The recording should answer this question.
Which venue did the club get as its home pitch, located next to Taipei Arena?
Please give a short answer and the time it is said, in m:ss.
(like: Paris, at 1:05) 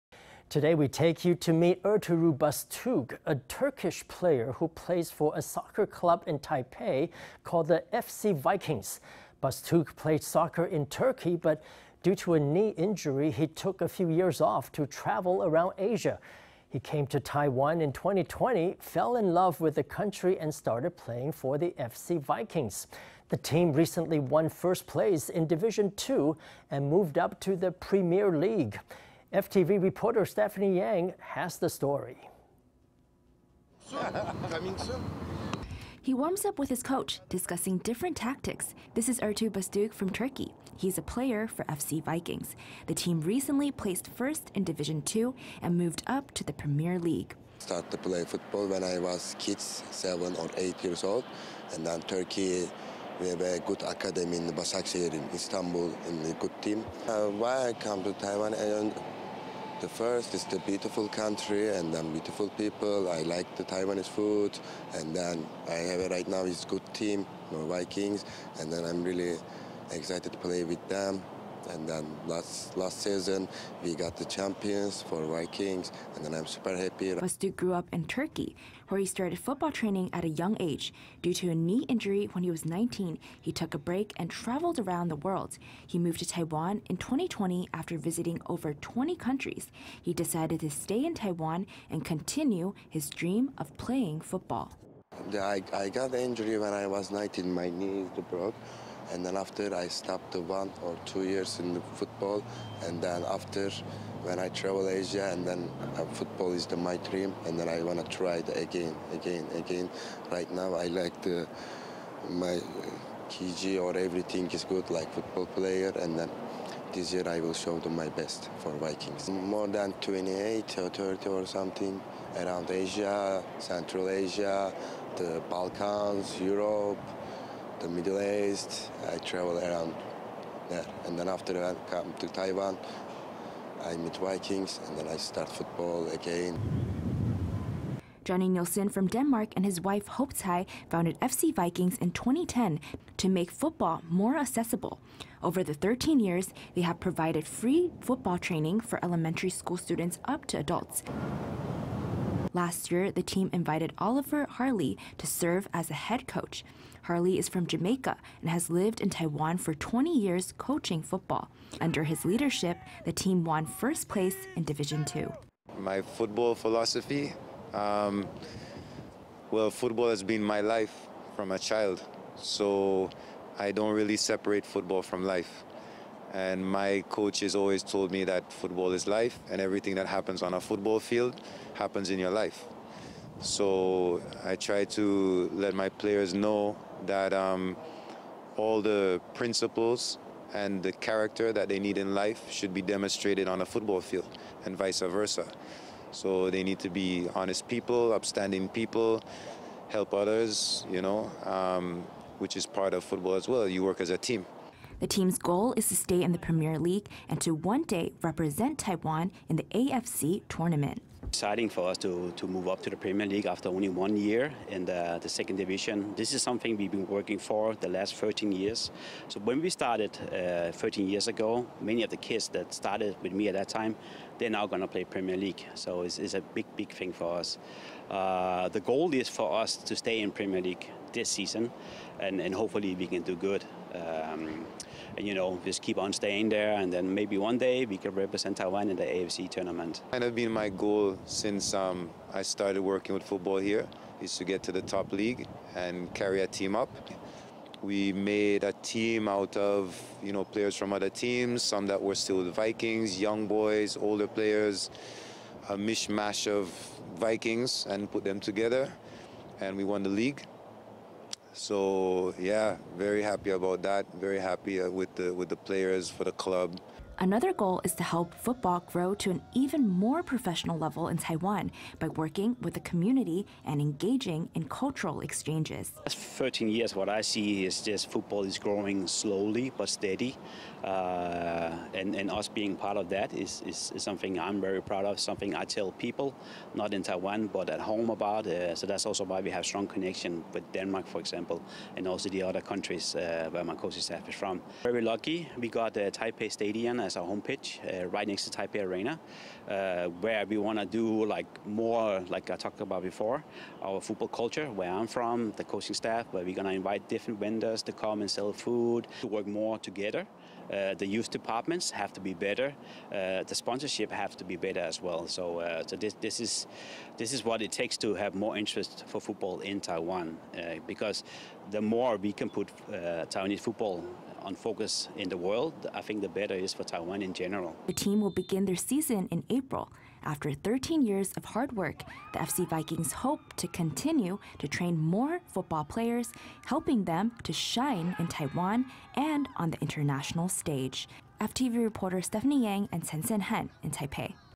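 Taipei Stadium, at 4:56.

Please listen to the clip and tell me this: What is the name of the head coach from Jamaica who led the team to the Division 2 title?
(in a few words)
Oliver Harley.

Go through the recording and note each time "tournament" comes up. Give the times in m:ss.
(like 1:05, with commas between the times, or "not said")
3:30, 3:59.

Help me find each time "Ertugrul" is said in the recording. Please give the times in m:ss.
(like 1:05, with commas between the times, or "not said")
0:01, 0:39.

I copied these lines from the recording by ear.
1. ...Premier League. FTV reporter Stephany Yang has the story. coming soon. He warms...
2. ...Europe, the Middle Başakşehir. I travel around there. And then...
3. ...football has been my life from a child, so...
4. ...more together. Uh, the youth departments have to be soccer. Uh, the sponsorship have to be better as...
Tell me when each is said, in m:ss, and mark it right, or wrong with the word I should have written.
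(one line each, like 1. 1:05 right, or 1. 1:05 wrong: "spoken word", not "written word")
1. 0:27 right
2. 2:06 wrong: "East", not "Başakşehir"
3. 2:49 right
4. 5:09 wrong: "better", not "soccer".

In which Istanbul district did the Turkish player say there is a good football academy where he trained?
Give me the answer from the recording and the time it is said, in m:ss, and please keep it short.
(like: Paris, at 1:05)
Başakşehir, at 0:54.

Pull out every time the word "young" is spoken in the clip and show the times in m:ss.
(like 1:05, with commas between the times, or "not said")
1:20, 4:13.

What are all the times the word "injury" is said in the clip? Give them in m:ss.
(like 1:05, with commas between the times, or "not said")
0:12, 1:21, 1:36.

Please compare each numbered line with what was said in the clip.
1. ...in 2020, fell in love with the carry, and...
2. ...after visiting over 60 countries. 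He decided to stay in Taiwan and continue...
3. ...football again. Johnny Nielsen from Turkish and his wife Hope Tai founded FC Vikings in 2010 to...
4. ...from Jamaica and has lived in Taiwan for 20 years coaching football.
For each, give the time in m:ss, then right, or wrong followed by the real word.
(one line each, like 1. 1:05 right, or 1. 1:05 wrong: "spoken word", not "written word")
1. 0:17 wrong: "country", not "carry"
2. 1:27 wrong: "20", not "60"
3. 2:15 wrong: "Denmark", not "Turkish"
4. 2:37 right.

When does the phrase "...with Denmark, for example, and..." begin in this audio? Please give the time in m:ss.
4:50.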